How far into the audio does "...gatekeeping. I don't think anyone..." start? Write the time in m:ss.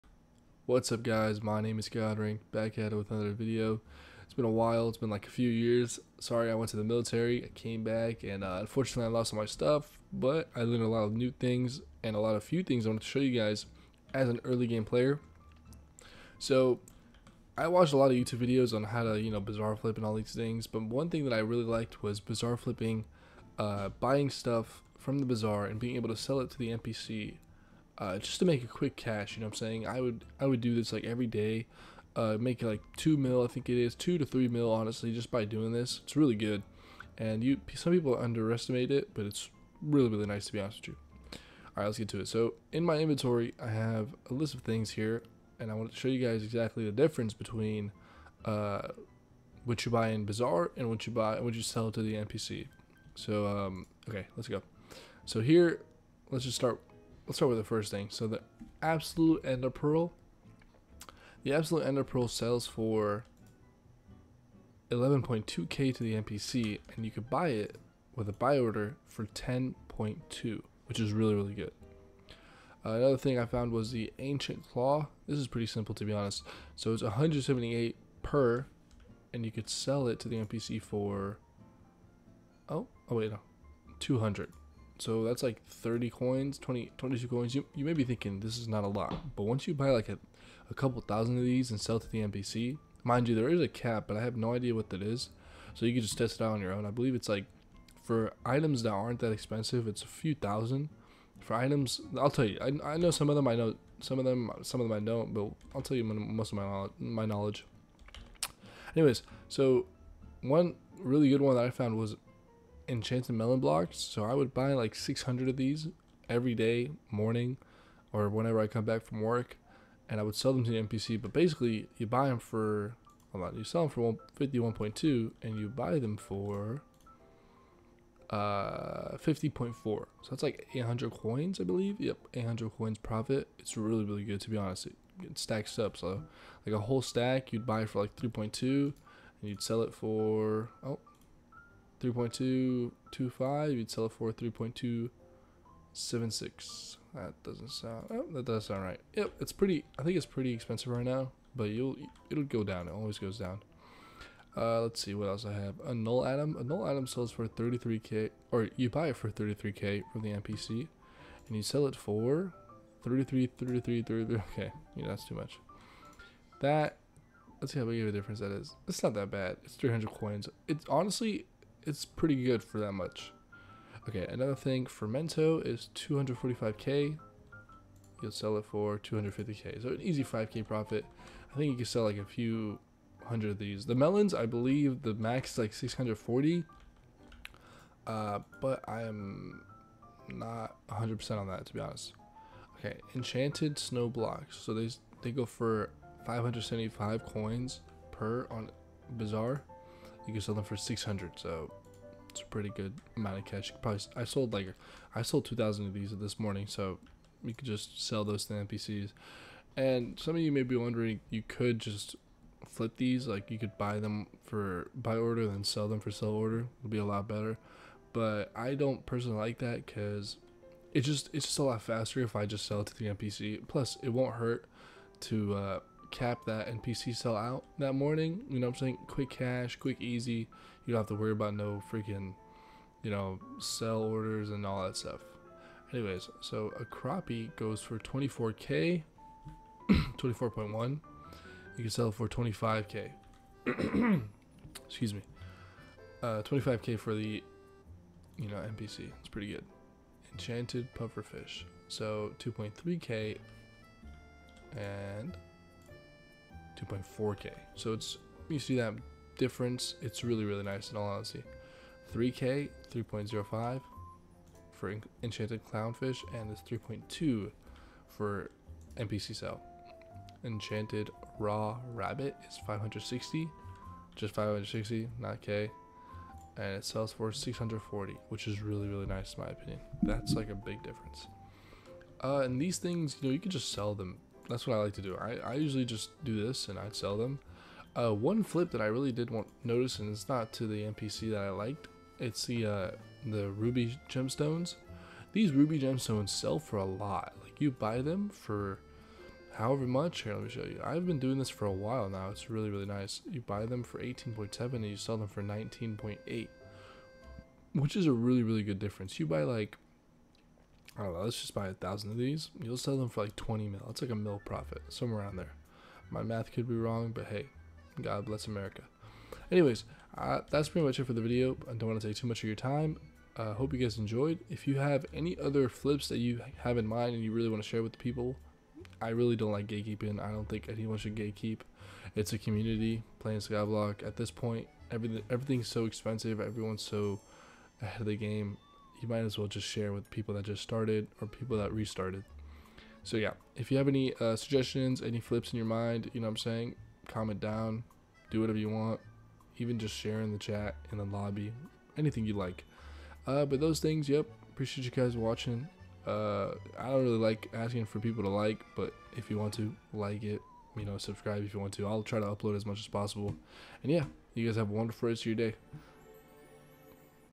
5:29.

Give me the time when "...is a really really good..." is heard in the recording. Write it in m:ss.
5:07.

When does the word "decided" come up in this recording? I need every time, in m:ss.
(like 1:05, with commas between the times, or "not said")
not said.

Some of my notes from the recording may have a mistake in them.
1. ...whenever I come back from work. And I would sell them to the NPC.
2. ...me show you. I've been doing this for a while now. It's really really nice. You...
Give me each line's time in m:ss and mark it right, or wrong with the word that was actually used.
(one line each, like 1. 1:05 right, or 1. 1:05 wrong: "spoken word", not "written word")
1. 1:58 right
2. 5:00 right.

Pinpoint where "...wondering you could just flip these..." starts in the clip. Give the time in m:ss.
3:30.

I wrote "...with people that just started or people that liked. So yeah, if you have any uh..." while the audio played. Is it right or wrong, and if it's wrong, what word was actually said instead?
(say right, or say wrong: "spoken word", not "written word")
wrong: "restarted", not "liked".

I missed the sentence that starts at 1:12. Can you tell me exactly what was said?
Uh, another thing I found was the ancient claw.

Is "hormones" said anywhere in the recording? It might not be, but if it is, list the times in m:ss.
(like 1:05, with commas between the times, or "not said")
not said.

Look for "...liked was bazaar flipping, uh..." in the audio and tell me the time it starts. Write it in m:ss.
0:21.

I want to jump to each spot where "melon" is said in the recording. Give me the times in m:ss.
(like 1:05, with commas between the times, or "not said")
1:53, 3:03.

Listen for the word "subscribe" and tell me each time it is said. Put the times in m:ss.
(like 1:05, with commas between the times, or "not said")
6:00.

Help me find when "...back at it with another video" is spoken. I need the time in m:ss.
0:02.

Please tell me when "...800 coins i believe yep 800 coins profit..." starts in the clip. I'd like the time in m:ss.
2:10.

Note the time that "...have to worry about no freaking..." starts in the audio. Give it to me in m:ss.
3:50.